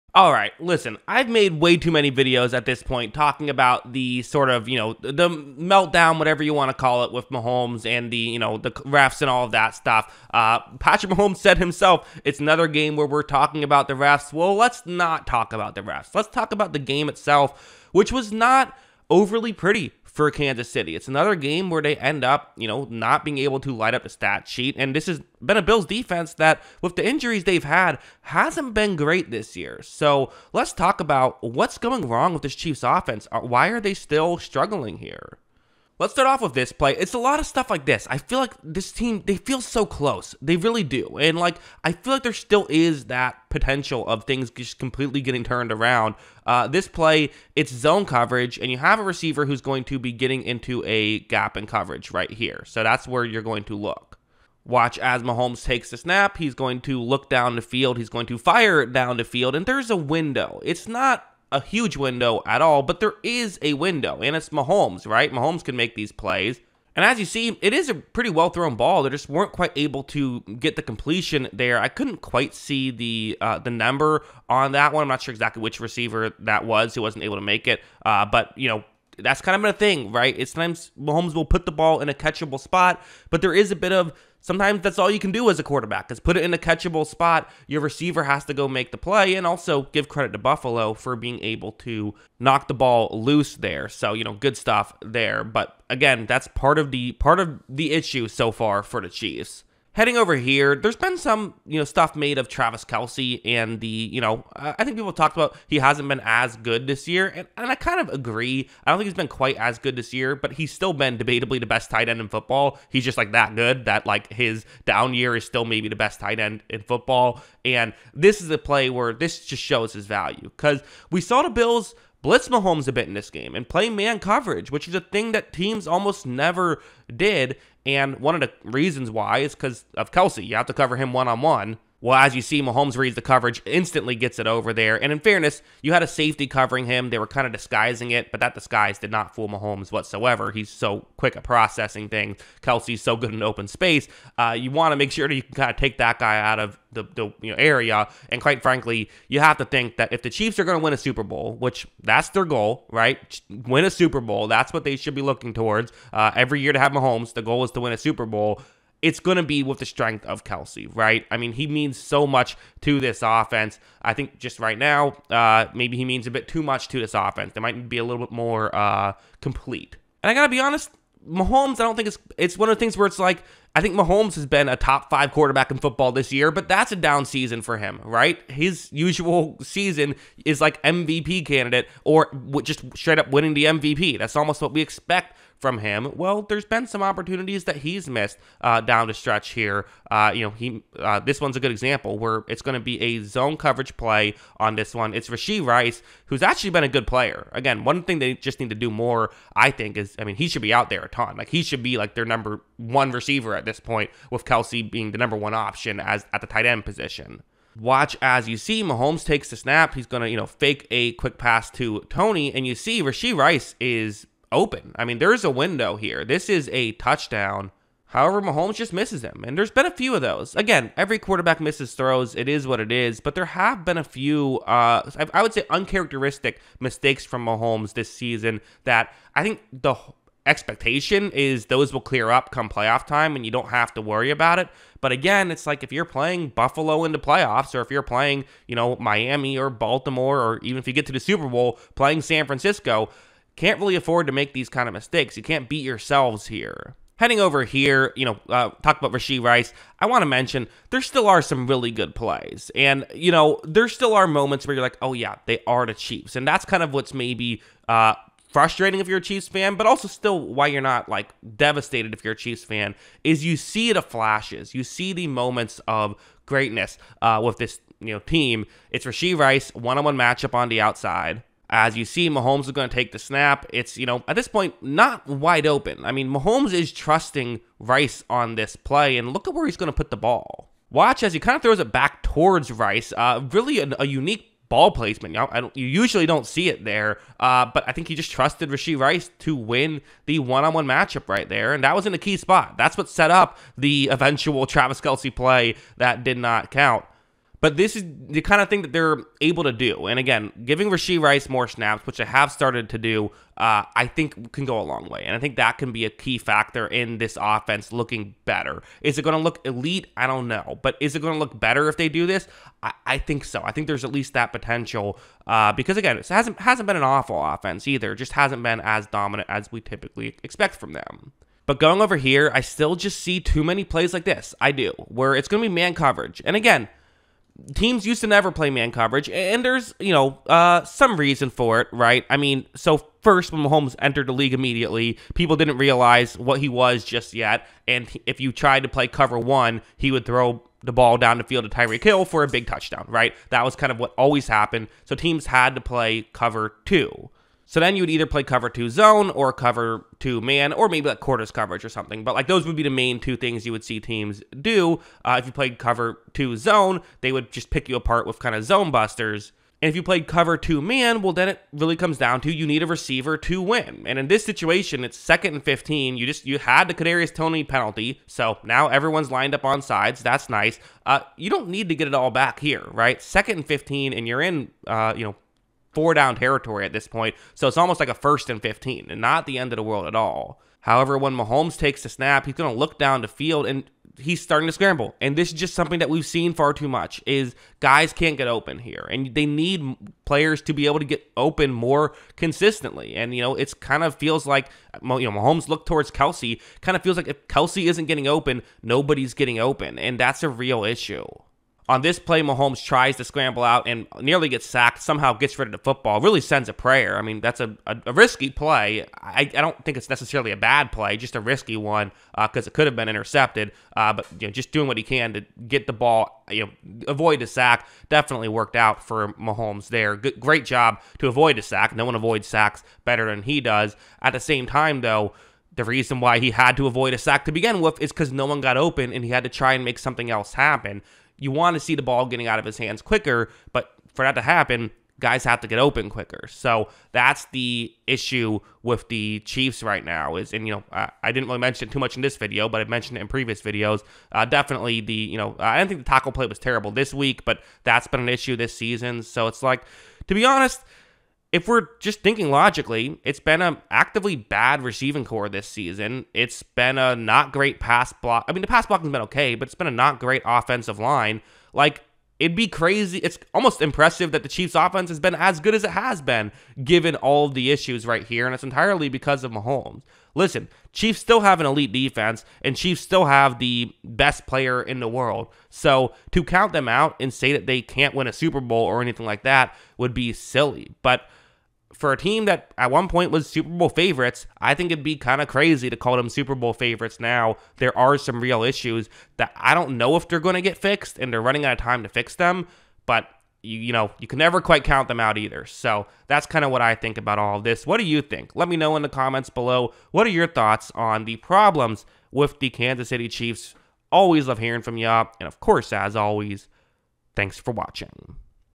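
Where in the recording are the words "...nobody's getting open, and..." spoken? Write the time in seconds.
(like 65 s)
398 s.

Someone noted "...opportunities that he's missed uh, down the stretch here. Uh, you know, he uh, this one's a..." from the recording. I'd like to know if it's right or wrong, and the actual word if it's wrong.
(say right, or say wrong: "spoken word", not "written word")
right.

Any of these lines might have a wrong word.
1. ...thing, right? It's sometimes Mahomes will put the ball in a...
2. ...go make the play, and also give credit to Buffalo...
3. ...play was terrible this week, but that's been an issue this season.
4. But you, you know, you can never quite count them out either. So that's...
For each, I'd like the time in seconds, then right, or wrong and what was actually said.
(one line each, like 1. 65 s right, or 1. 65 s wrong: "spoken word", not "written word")
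1. 79 s right
2. 88 s right
3. 446 s right
4. 493 s right.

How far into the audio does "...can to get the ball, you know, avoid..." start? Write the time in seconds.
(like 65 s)
415 s.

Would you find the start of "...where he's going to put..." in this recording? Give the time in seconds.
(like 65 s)
279 s.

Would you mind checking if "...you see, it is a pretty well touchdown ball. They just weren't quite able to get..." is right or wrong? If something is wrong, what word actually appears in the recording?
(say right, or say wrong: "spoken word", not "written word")
wrong: "thrown", not "touchdown".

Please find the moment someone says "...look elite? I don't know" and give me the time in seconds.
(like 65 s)
309 s.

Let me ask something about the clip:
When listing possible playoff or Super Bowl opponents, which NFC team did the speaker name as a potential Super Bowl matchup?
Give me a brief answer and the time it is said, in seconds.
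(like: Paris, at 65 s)
San Francisco, at 242 s.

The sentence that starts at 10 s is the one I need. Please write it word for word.
Uh, Patrick Mahomes said himself, it's another game where we're talking about the refs.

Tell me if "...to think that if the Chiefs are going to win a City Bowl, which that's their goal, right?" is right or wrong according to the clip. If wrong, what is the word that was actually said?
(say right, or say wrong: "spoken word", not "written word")
wrong: "Super", not "City".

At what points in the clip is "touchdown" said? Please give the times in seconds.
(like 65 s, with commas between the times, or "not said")
216 s, 342 s.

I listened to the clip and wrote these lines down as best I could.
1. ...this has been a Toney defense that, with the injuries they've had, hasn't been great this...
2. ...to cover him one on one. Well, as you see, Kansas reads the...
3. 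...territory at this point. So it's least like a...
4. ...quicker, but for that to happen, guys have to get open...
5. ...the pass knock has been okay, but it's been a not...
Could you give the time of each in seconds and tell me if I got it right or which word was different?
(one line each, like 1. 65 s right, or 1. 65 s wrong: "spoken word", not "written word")
1. 24 s wrong: "Bills", not "Toney"
2. 130 s wrong: "Mahomes", not "Kansas"
3. 376 s wrong: "almost", not "least"
4. 433 s right
5. 458 s wrong: "block", not "knock".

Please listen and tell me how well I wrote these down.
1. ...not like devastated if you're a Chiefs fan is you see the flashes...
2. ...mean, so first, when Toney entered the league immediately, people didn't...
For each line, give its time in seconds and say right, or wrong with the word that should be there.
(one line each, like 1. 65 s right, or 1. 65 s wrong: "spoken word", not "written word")
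1. 260 s right
2. 332 s wrong: "Mahomes", not "Toney".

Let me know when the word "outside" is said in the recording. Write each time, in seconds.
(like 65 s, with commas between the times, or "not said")
270 s.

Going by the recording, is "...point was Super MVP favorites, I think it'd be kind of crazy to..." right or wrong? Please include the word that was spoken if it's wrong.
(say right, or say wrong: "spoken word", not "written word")
wrong: "Bowl", not "MVP".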